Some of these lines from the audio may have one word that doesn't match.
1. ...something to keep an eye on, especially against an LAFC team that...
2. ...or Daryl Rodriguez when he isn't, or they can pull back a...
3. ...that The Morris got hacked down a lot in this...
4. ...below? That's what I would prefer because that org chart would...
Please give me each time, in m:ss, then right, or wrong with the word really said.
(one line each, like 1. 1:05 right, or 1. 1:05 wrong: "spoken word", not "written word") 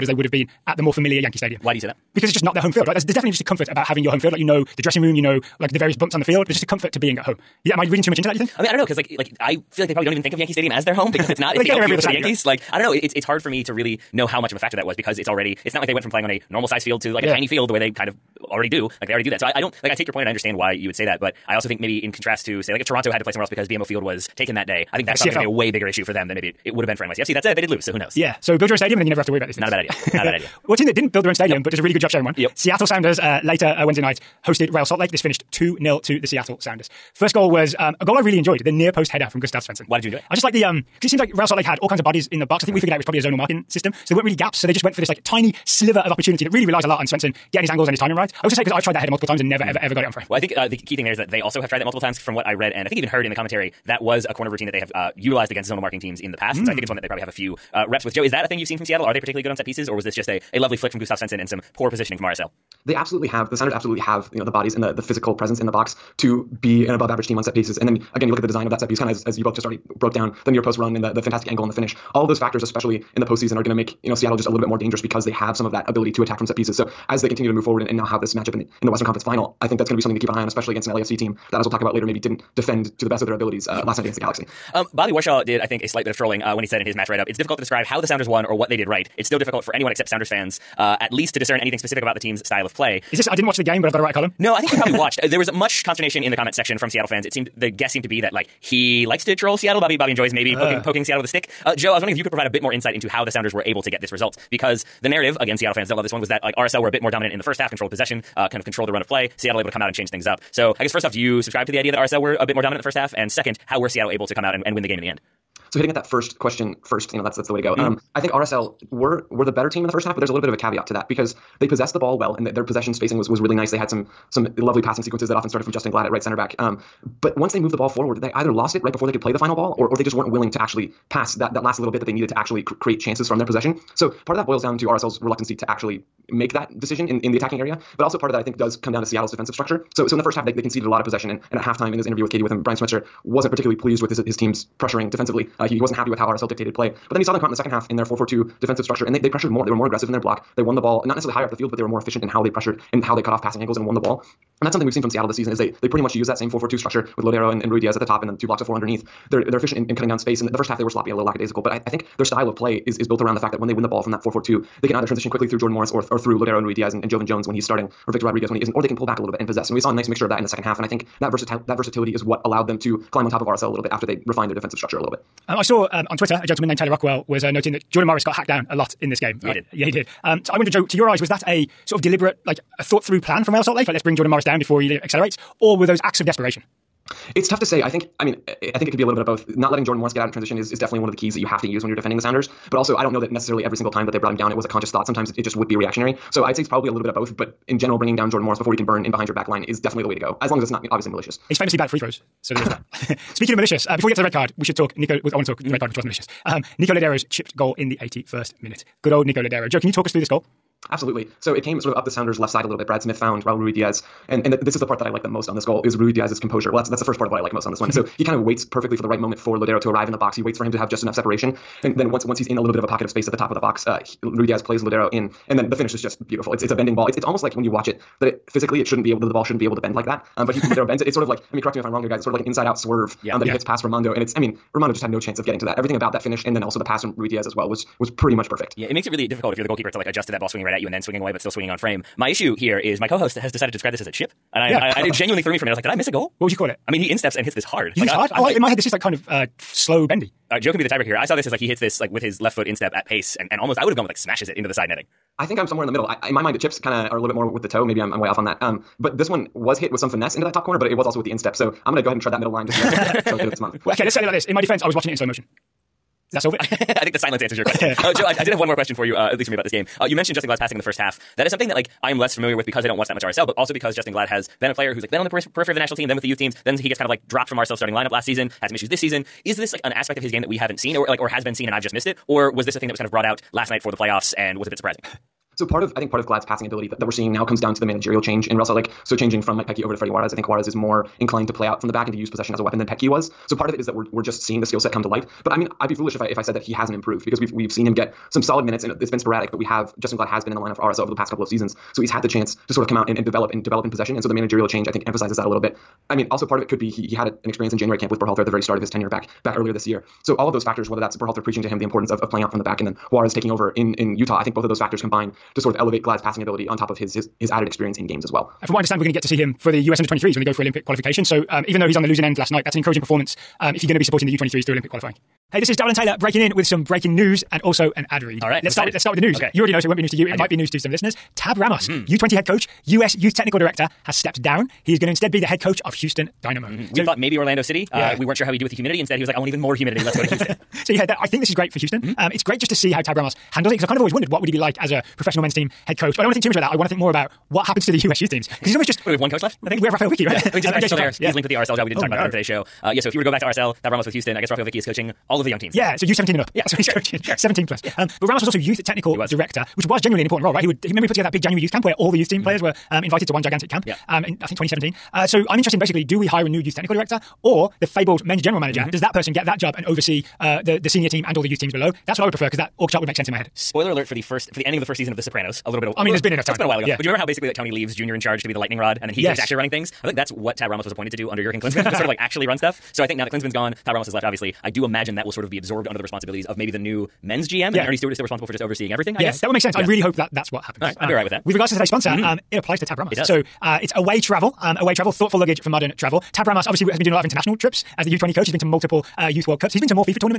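1. 1:19 right
2. 2:48 wrong: "Victor", not "Daryl"
3. 2:57 wrong: "Jordan", not "The"
4. 6:11 right.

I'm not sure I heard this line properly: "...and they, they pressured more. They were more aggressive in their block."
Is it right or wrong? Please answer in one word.
right.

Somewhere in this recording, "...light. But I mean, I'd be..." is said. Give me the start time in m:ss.
4:55.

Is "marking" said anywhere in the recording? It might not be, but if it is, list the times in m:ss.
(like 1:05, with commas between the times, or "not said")
0:43, 0:55.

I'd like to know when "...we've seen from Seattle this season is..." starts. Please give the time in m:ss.
2:34.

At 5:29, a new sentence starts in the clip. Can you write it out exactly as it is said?
Okay, you already know, so it won't be news to you.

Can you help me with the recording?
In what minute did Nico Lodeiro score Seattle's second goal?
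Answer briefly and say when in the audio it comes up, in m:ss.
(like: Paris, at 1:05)
81st, at 3:27.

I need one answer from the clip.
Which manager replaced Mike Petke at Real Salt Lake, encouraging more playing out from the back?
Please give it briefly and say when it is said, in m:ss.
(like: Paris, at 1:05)
Freddie Juarez, at 4:49.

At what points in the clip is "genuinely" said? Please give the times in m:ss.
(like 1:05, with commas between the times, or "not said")
4:05, 5:59.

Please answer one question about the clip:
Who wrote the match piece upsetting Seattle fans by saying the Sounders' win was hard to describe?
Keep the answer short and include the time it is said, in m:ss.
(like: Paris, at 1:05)
Bobby Warshaw, at 1:24.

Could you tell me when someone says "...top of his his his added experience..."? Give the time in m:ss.
5:16.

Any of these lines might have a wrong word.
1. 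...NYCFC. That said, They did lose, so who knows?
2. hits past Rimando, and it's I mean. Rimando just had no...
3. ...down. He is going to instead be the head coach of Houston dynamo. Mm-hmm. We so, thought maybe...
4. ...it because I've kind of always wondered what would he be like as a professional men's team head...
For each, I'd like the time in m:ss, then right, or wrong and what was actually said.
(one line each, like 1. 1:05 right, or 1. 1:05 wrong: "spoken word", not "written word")
1. 0:27 right
2. 3:53 right
3. 5:34 right
4. 5:43 right.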